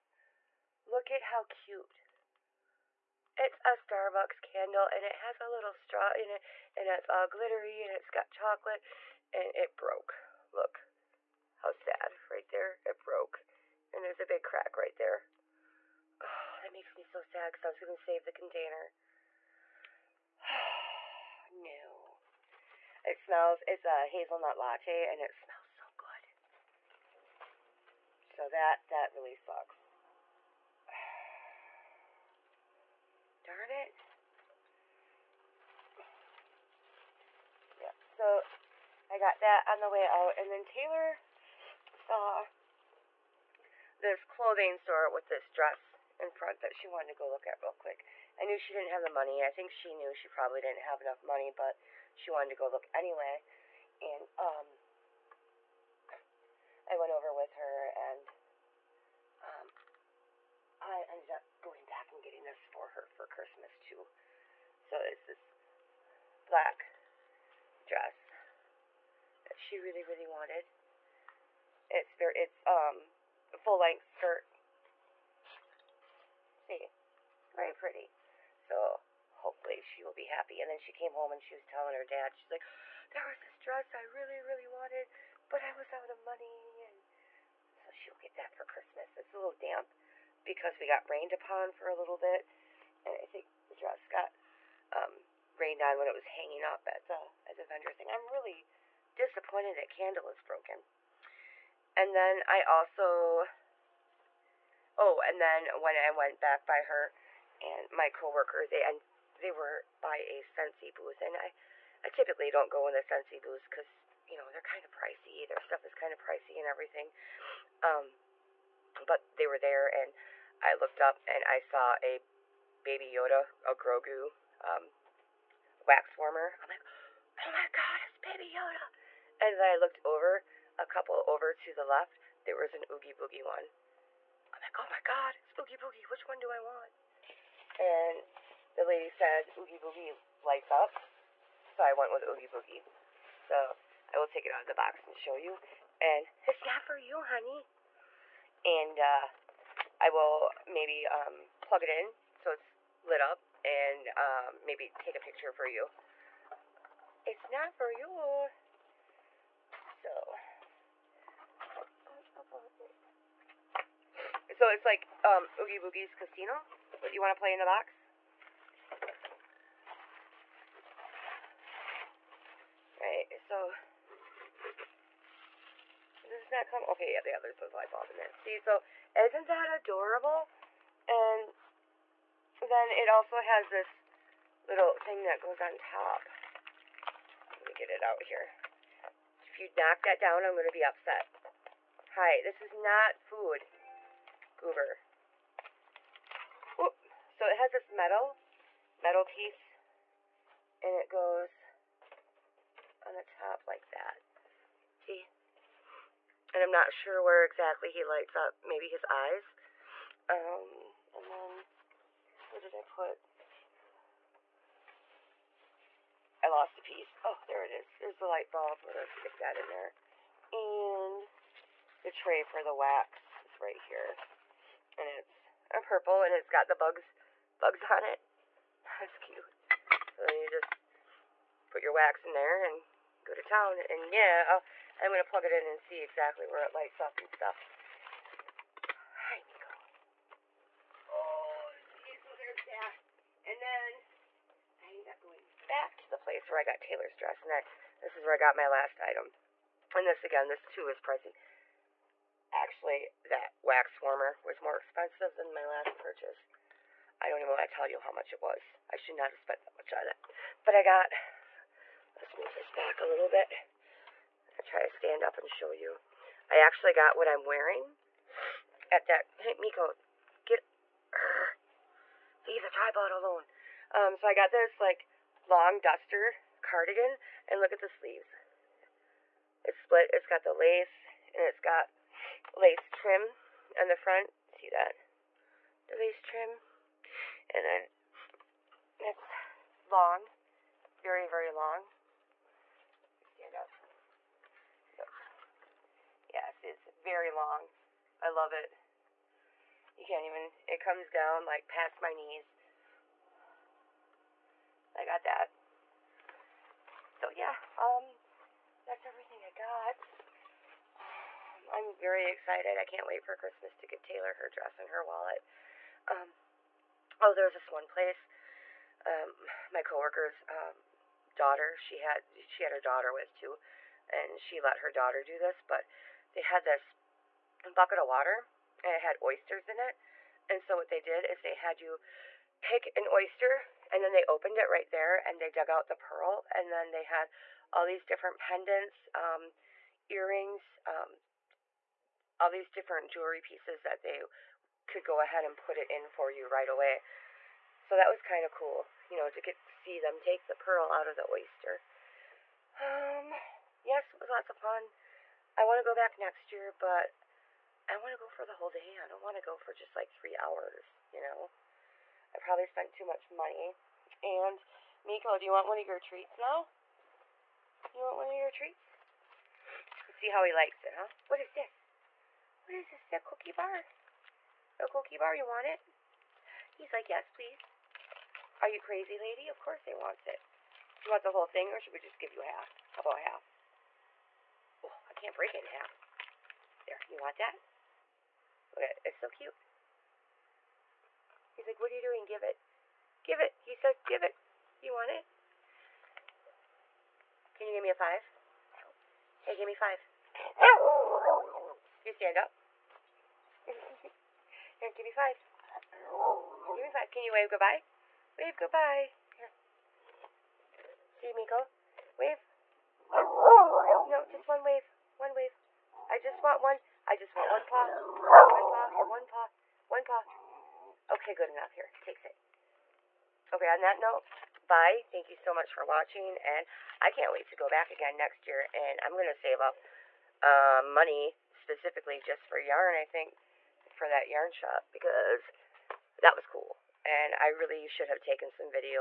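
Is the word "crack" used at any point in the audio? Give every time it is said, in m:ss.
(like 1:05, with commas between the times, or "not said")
0:14.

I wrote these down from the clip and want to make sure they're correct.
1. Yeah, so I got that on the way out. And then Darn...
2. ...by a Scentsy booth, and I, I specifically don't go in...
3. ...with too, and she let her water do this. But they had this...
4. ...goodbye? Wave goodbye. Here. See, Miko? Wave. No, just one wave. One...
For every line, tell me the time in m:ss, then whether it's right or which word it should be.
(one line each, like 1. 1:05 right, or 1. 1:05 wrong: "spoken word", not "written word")
1. 0:37 wrong: "Taylor", not "Darn"
2. 1:50 wrong: "typically", not "specifically"
3. 5:23 wrong: "daughter", not "water"
4. 6:47 right.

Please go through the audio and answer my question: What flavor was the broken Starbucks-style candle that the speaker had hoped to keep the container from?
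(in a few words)
hazelnut latte.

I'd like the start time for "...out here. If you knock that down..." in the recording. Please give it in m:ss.
3:08.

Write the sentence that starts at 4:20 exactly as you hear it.
But I got, let's move this back a little bit.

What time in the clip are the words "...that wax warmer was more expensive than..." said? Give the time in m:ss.
4:13.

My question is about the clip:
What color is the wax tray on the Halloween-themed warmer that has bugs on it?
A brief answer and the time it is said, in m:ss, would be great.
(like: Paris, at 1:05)
purple, at 3:45.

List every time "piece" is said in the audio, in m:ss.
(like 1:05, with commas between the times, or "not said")
3:19, 3:36, 5:43.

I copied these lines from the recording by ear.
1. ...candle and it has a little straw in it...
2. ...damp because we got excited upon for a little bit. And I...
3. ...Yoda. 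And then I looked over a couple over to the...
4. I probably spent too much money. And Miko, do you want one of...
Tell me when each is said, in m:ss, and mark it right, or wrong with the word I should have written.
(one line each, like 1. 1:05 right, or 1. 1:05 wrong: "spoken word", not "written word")
1. 0:04 right
2. 1:29 wrong: "rained", not "excited"
3. 2:08 right
4. 6:02 right.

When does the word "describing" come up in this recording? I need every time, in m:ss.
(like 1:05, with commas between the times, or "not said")
not said.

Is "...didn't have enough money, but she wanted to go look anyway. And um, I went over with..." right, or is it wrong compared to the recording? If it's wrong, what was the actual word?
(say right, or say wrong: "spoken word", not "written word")
right.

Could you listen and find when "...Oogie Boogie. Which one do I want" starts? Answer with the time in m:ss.
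2:15.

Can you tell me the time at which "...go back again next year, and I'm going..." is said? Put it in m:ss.
7:07.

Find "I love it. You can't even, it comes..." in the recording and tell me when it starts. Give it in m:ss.
4:58.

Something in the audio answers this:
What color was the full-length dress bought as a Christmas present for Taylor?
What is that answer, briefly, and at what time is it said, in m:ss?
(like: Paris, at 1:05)
black, at 1:06.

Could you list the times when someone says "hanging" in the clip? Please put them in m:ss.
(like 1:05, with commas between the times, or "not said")
1:36.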